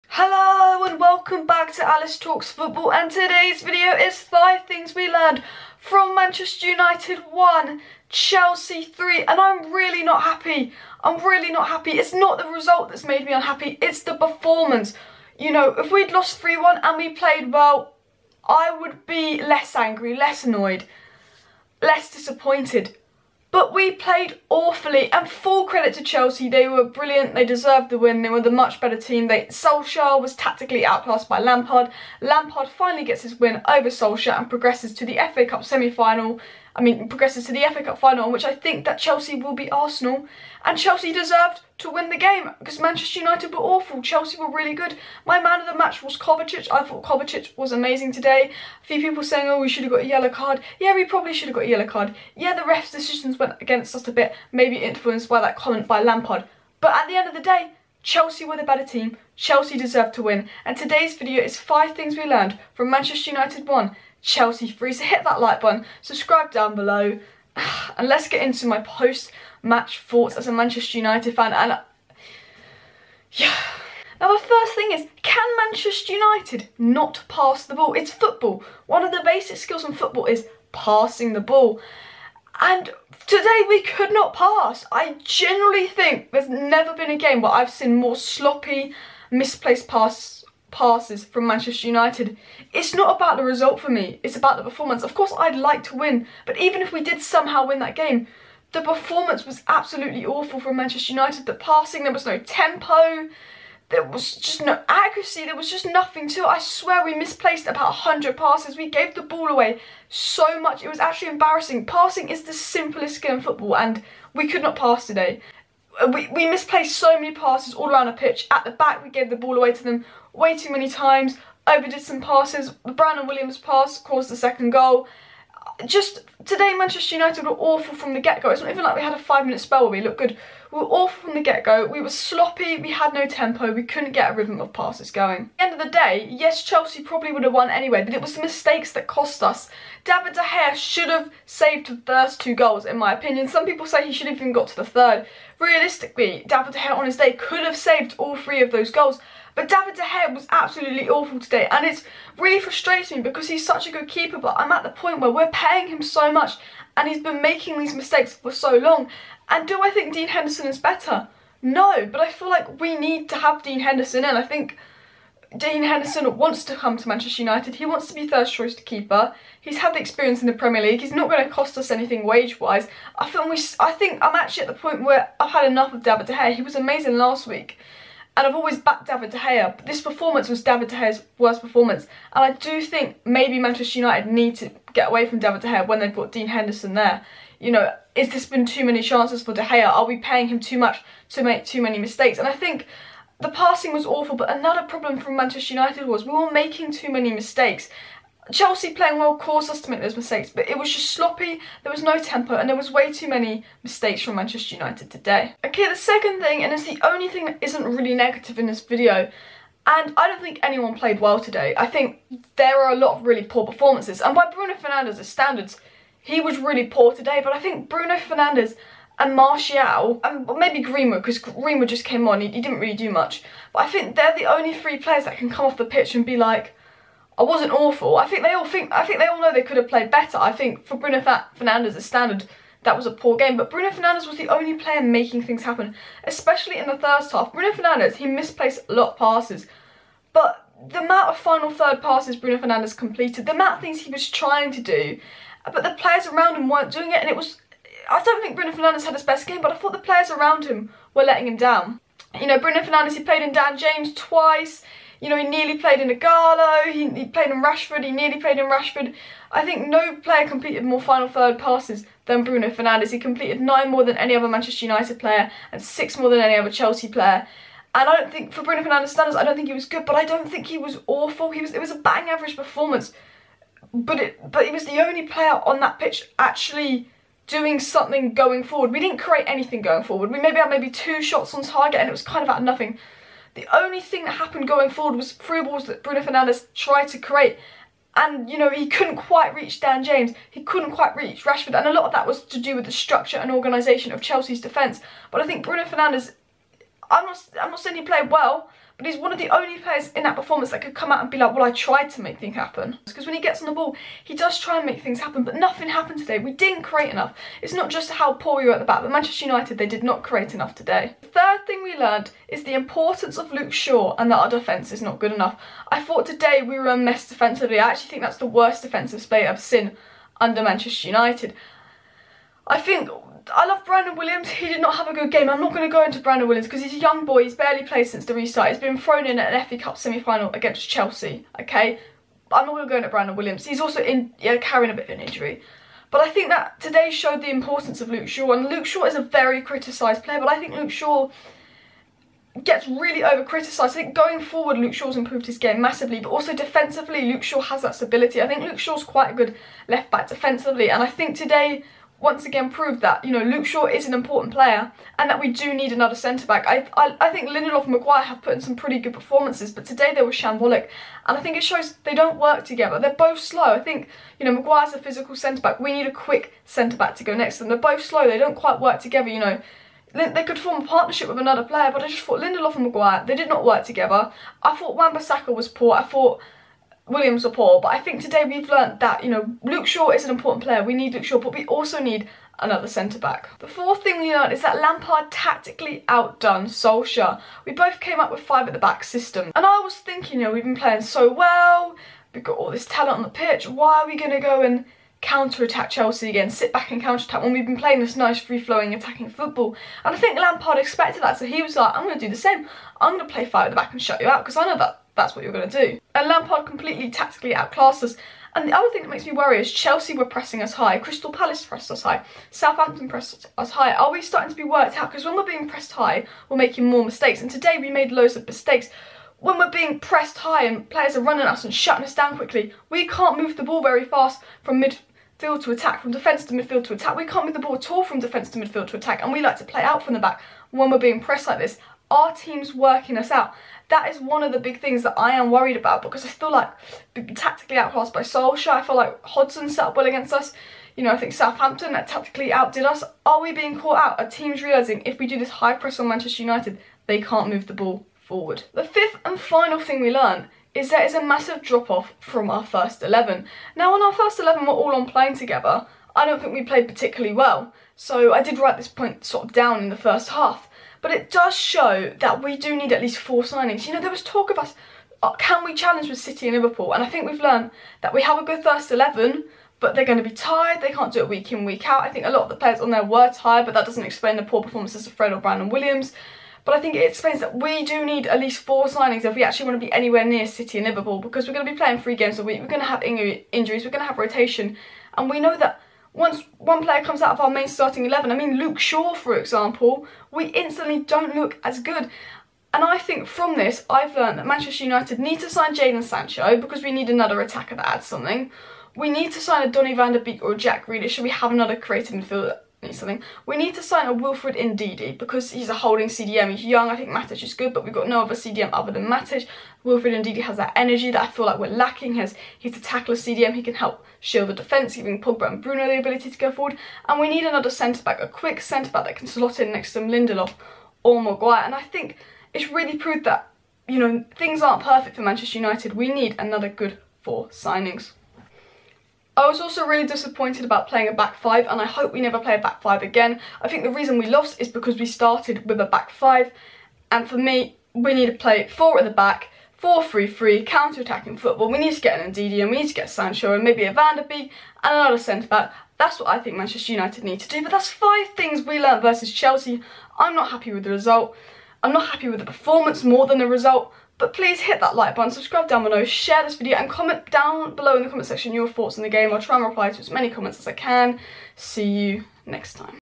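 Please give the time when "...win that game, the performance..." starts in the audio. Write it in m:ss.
1:37.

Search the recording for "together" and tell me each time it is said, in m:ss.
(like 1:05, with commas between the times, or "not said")
6:02, 6:09, 6:13, 7:35.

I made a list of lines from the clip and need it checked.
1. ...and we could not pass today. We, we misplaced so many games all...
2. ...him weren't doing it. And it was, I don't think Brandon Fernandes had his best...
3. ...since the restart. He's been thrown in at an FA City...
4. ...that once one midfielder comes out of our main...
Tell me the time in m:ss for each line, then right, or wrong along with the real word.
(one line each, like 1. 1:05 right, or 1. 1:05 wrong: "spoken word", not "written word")
1. 1:53 wrong: "passes", not "games"
2. 4:06 wrong: "Bruno", not "Brandon"
3. 5:28 wrong: "Cup", not "City"
4. 8:05 wrong: "player", not "midfielder".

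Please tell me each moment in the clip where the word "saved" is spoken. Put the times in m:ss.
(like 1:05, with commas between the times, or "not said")
2:21, 2:27.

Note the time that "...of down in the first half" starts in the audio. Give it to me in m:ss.
7:39.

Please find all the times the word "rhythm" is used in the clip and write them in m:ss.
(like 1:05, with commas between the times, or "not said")
2:14.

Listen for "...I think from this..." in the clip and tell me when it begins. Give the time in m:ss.
8:12.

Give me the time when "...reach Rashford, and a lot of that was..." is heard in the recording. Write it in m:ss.
4:51.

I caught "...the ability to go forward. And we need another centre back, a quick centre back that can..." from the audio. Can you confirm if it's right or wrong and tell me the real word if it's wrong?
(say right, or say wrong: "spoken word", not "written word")
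right.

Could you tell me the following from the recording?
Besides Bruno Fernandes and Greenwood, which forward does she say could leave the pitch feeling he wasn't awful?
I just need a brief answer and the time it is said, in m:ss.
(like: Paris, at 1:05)
Martial, at 3:39.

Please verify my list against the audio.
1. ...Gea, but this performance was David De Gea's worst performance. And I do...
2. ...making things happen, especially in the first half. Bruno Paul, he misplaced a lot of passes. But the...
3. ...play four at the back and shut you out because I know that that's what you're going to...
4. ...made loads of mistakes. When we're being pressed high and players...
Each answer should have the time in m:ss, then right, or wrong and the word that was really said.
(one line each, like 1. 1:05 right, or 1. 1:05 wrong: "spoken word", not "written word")
1. 2:59 right
2. 3:55 wrong: "Fernandes", not "Paul"
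3. 6:43 wrong: "five", not "four"
4. 6:57 right.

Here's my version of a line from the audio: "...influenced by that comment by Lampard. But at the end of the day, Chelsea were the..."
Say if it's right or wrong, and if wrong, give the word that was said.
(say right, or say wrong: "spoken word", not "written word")
right.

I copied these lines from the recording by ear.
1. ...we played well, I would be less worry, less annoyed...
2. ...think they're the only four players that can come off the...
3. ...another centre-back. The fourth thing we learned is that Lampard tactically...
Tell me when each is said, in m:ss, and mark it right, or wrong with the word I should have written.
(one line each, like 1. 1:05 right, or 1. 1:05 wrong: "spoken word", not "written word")
1. 0:16 wrong: "angry", not "worry"
2. 3:43 wrong: "three", not "four"
3. 6:22 right.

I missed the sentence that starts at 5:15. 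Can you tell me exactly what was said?
I thought today we were a mess defensively.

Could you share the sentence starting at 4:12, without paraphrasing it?
You know, Bruno Fernandes, he played in Dan James twice.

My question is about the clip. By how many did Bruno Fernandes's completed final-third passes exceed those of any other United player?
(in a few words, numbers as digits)
9.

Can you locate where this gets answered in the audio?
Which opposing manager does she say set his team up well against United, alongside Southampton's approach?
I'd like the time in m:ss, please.
7:19.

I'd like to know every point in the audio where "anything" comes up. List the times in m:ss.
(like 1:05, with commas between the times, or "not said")
2:51, 4:39.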